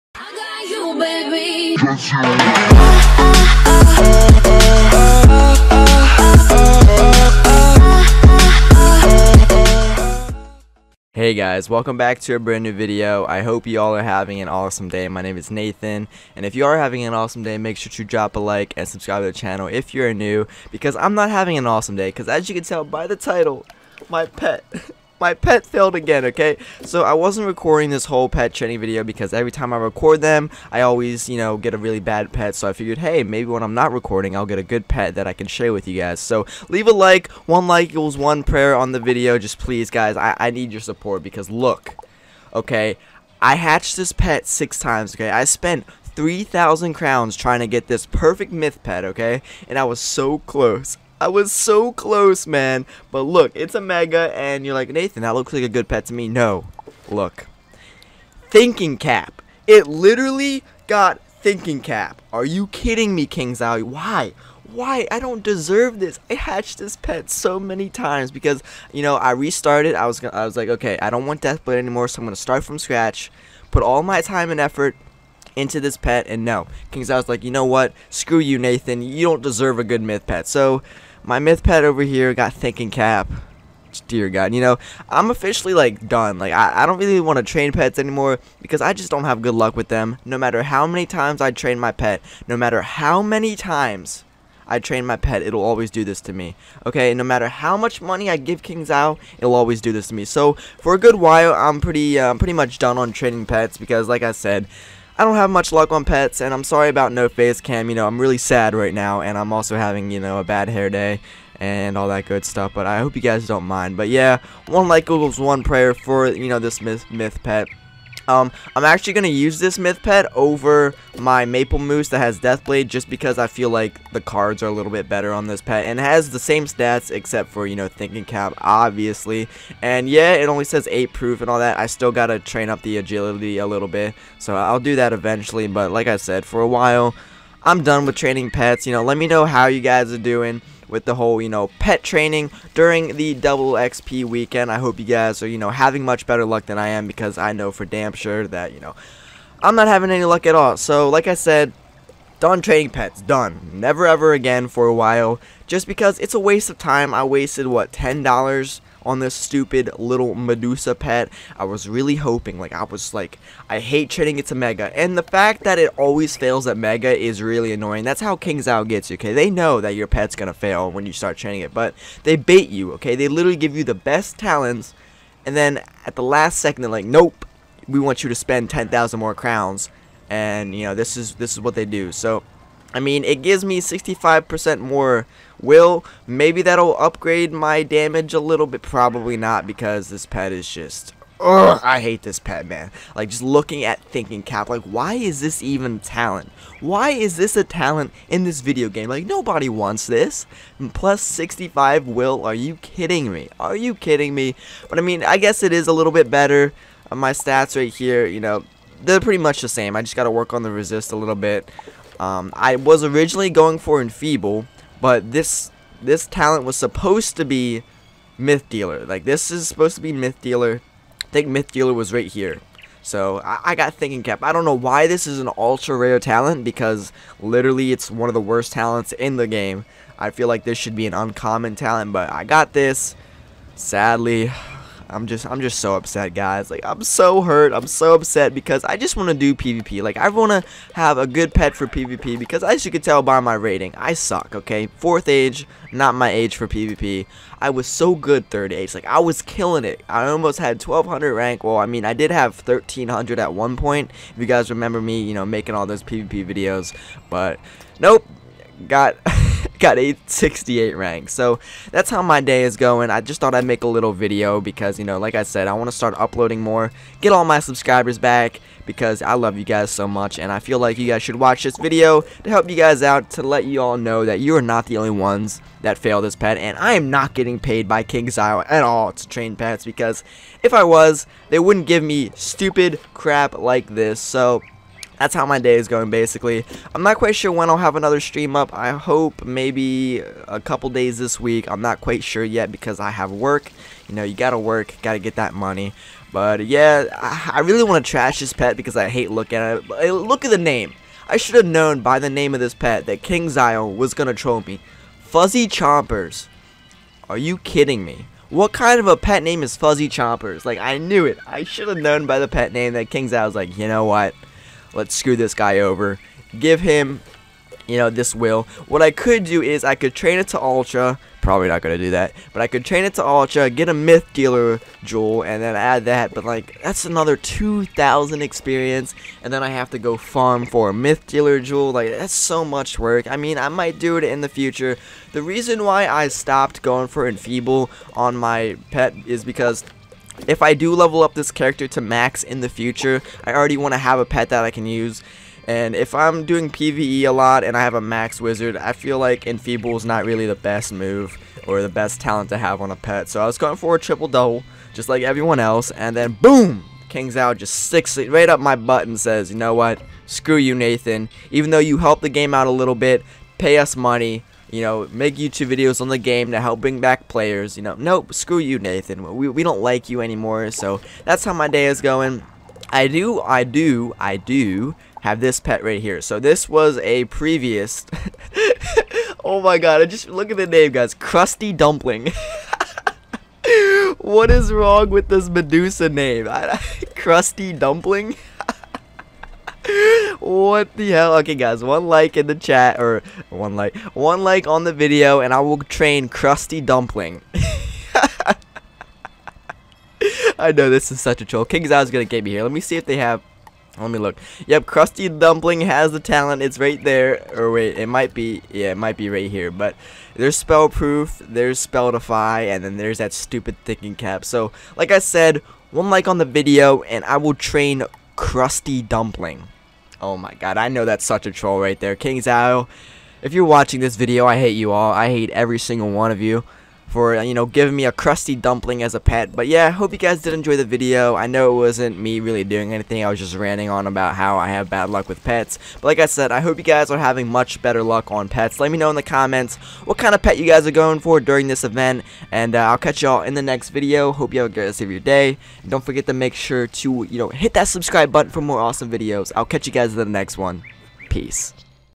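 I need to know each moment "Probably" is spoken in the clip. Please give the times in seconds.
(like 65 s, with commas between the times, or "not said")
188 s, 321 s.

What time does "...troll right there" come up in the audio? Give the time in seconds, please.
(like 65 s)
421 s.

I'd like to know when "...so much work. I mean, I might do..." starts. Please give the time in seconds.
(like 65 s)
332 s.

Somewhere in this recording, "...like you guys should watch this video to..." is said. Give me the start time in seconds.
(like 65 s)
270 s.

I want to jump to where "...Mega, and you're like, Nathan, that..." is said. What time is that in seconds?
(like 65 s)
53 s.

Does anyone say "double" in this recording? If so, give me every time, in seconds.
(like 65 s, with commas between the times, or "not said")
143 s, 354 s.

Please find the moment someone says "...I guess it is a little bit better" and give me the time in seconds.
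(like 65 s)
205 s.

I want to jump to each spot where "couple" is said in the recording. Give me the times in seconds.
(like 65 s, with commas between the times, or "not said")
290 s.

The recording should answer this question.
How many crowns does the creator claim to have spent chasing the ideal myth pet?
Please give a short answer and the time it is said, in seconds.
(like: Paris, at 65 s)
3,000, at 46 s.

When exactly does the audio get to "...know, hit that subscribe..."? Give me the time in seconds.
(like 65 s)
447 s.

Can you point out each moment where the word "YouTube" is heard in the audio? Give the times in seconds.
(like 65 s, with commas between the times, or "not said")
365 s.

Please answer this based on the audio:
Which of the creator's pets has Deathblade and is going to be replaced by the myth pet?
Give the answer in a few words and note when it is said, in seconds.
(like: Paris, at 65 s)
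Maple Moose, at 121 s.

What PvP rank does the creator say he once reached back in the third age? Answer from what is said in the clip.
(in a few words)
1300.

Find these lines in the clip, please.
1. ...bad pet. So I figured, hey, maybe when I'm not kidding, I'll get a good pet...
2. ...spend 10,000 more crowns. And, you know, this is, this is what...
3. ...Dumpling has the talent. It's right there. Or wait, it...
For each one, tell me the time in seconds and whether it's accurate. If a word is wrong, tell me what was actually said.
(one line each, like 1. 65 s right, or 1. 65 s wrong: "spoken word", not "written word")
1. 32 s wrong: "recording", not "kidding"
2. 178 s right
3. 405 s right.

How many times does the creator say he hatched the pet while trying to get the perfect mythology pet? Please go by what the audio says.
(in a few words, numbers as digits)
6.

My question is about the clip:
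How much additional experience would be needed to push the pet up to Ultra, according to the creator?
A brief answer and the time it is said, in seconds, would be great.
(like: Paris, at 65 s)
2,000, at 327 s.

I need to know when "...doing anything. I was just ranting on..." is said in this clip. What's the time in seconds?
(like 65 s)
432 s.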